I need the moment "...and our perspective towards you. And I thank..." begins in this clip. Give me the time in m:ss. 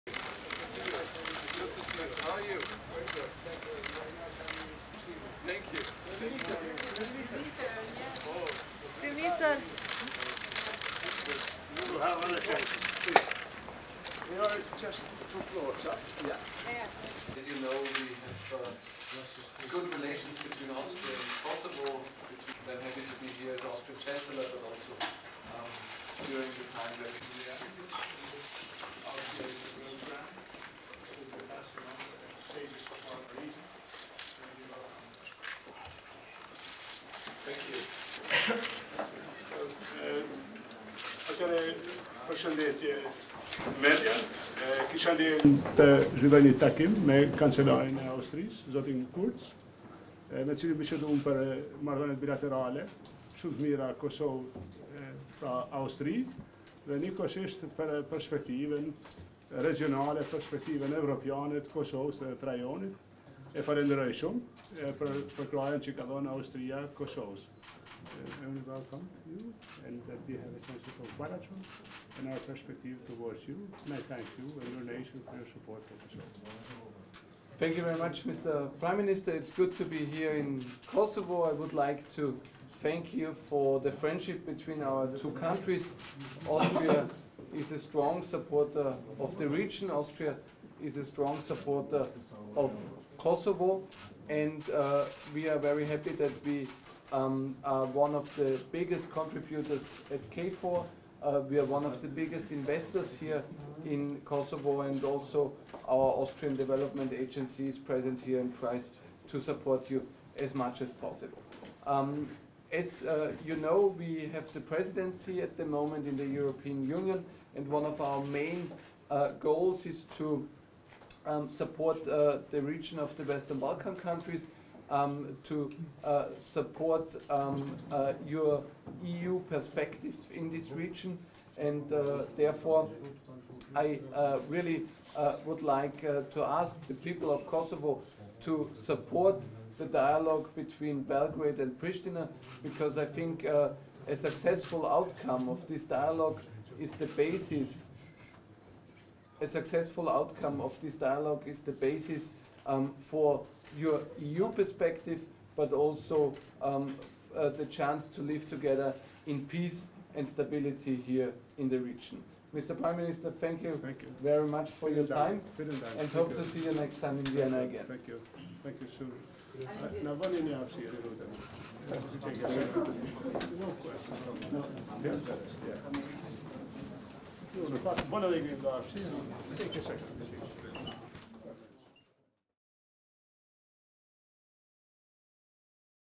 1:12.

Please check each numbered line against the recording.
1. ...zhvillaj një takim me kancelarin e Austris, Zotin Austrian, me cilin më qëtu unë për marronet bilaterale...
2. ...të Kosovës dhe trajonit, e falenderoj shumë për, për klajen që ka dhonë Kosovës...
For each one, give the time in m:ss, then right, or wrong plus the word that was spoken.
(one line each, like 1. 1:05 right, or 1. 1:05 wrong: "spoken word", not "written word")
1. 0:46 wrong: "Kurz", not "Austrian"
2. 1:01 wrong: "Austria", not "Kosovës".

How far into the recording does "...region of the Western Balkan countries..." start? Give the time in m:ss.
2:02.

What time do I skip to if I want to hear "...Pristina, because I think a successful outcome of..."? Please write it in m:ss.
2:21.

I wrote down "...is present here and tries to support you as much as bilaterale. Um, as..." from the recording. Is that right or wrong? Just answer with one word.
wrong.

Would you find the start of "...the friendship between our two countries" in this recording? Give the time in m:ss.
1:23.